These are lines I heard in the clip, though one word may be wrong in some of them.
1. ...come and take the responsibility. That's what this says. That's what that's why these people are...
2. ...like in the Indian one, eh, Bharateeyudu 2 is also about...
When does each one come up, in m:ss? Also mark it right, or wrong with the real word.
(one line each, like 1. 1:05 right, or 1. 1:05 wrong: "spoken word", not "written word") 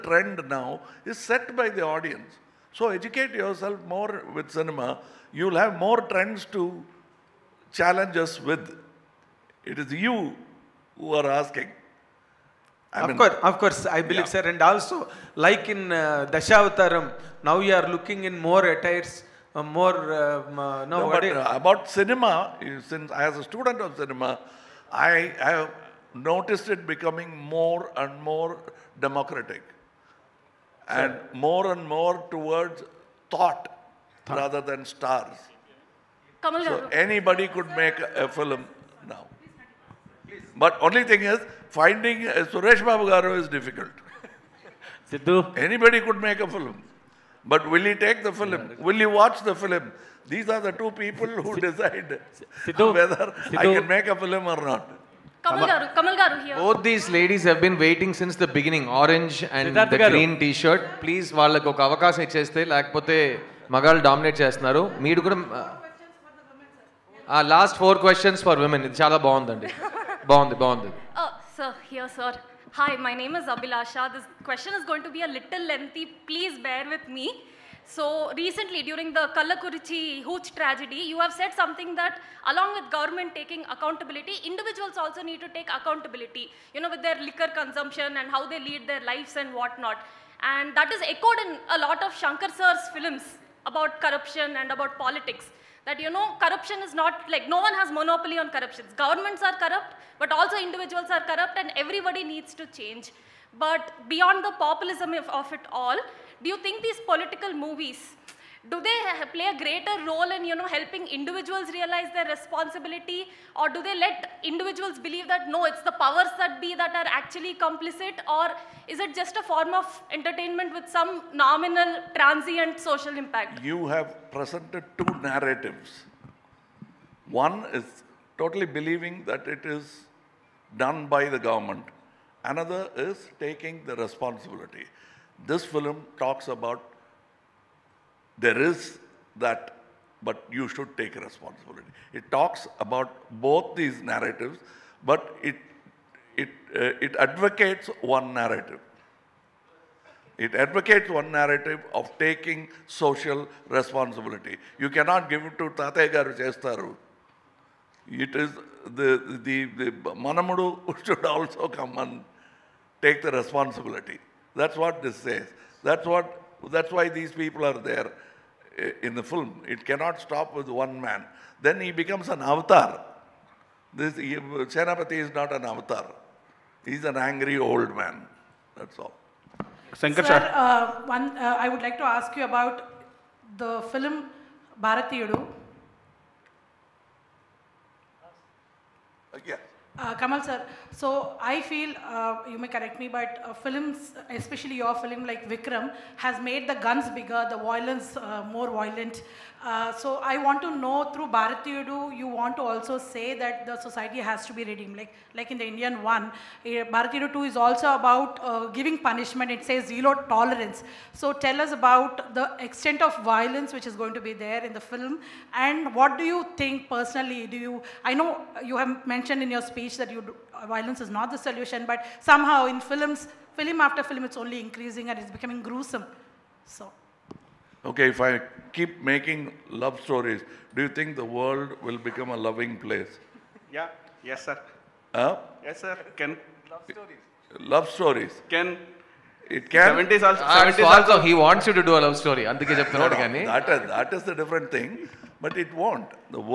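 1. 2:41 right
2. 3:25 right.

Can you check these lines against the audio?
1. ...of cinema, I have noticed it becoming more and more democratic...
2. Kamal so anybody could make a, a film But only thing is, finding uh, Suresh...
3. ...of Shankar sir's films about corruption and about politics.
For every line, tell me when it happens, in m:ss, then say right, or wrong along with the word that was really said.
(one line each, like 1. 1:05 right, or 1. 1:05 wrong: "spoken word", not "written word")
1. 0:23 right
2. 0:36 right
3. 1:32 right.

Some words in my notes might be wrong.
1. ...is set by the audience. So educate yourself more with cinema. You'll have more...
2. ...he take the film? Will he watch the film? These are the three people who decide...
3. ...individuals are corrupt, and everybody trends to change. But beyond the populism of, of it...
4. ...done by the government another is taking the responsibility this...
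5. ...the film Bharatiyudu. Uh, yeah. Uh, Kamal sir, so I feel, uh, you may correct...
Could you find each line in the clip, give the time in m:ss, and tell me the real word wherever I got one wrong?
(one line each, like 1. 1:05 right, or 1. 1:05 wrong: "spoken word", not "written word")
1. 0:01 right
2. 0:47 wrong: "two", not "three"
3. 1:40 wrong: "needs", not "trends"
4. 2:10 right
5. 3:03 right.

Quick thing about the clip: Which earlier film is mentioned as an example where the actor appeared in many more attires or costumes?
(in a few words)
Dashavataram.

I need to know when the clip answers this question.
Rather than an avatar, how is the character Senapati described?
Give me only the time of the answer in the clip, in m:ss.
2:57.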